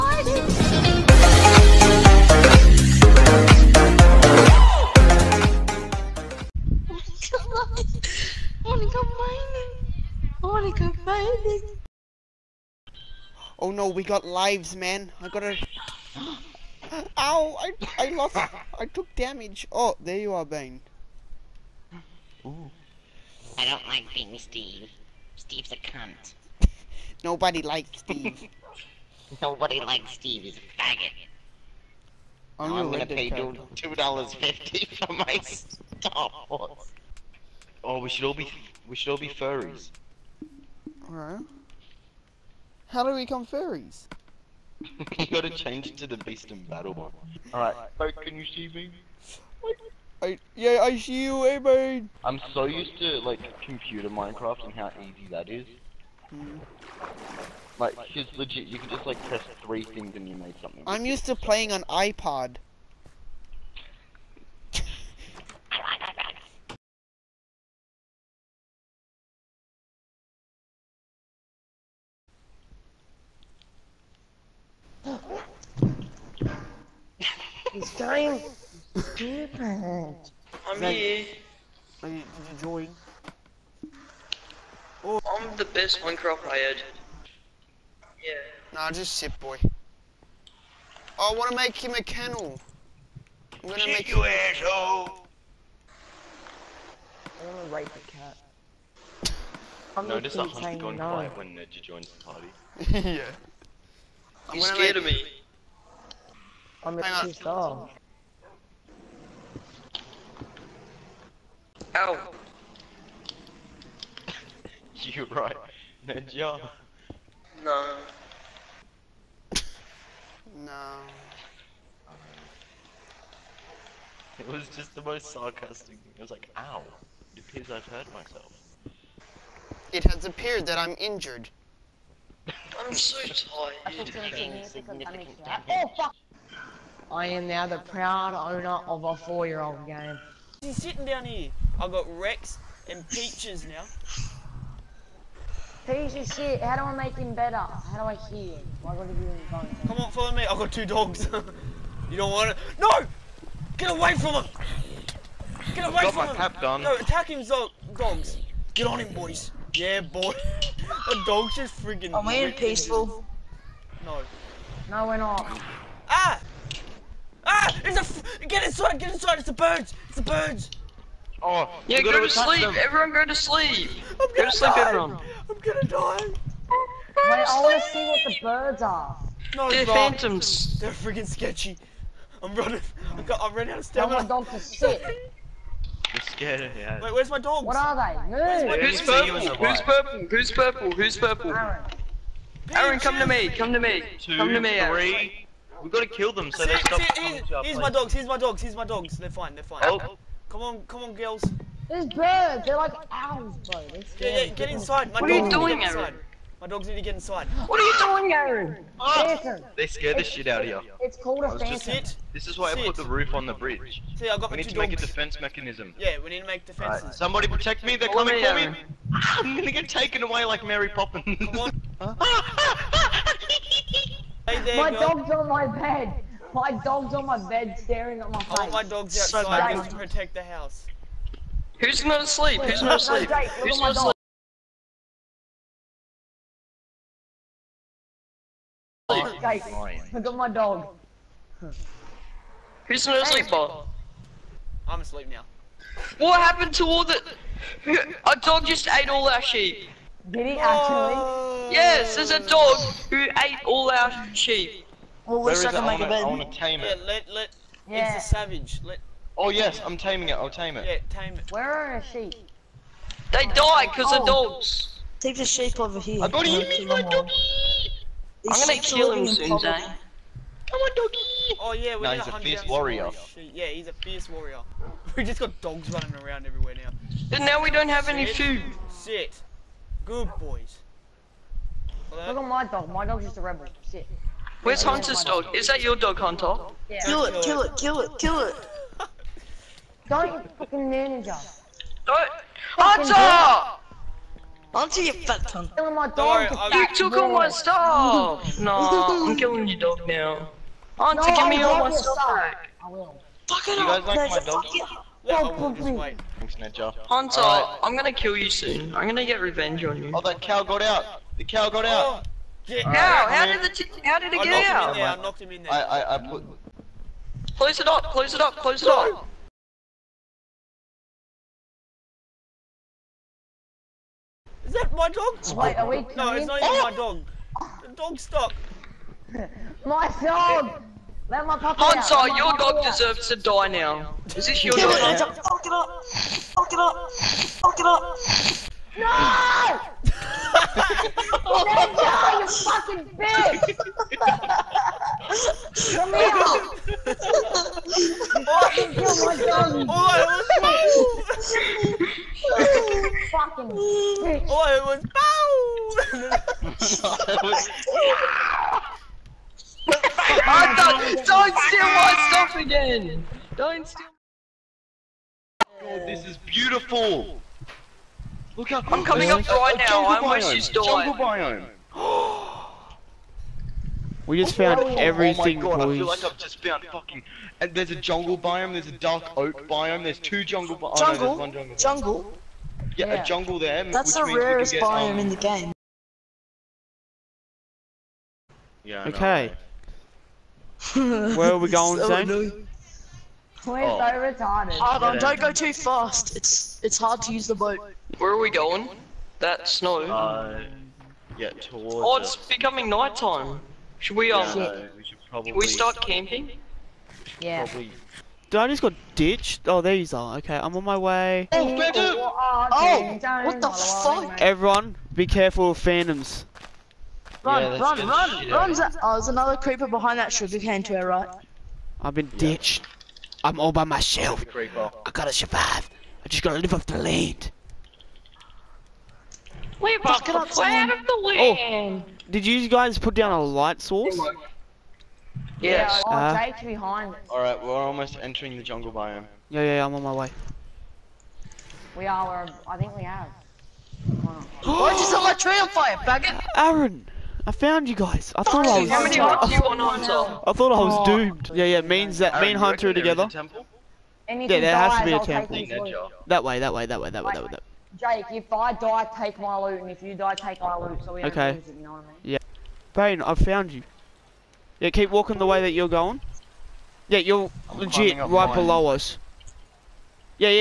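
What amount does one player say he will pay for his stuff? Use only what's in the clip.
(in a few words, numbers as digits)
$2.50.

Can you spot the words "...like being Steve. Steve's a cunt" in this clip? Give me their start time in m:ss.
0:23.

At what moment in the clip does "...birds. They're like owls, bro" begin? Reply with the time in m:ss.
3:22.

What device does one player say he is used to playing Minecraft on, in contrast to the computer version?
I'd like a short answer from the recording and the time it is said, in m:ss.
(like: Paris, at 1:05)
iPod, at 1:01.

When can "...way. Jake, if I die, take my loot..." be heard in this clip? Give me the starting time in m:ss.
7:37.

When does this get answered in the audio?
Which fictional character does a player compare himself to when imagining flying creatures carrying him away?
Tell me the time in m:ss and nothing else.
3:40.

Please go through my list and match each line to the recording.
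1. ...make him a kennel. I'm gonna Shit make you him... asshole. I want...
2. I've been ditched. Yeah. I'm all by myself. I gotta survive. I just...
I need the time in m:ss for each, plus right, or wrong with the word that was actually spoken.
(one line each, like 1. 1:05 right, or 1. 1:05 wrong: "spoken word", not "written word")
1. 1:31 right
2. 7:02 right.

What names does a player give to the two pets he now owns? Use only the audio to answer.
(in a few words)
Rex and Peaches.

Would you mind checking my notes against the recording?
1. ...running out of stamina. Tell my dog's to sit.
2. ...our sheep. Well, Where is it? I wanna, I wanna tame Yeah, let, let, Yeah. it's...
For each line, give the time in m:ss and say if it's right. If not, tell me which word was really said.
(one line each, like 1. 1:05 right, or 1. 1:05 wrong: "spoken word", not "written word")
1. 3:03 right
2. 4:13 right.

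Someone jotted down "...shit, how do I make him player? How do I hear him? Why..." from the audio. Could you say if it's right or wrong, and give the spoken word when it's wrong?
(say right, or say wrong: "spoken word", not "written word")
wrong: "better", not "player".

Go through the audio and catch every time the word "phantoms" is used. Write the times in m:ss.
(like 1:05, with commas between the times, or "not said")
2:59, 3:31, 6:55.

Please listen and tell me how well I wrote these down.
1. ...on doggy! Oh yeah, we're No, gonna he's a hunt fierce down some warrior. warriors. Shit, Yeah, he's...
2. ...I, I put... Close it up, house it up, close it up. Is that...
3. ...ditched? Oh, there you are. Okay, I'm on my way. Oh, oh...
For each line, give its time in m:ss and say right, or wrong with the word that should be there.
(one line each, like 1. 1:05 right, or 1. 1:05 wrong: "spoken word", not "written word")
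1. 4:30 right
2. 5:15 wrong: "close", not "house"
3. 6:49 right.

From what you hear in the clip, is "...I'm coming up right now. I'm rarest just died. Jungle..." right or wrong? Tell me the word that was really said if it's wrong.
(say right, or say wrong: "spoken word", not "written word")
wrong: "almost", not "rarest".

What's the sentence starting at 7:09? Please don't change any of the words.
We're off the of the Oh, did you guys put down a light source?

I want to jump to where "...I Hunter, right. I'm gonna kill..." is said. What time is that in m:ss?
5:05.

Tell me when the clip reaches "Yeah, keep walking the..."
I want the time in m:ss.
7:44.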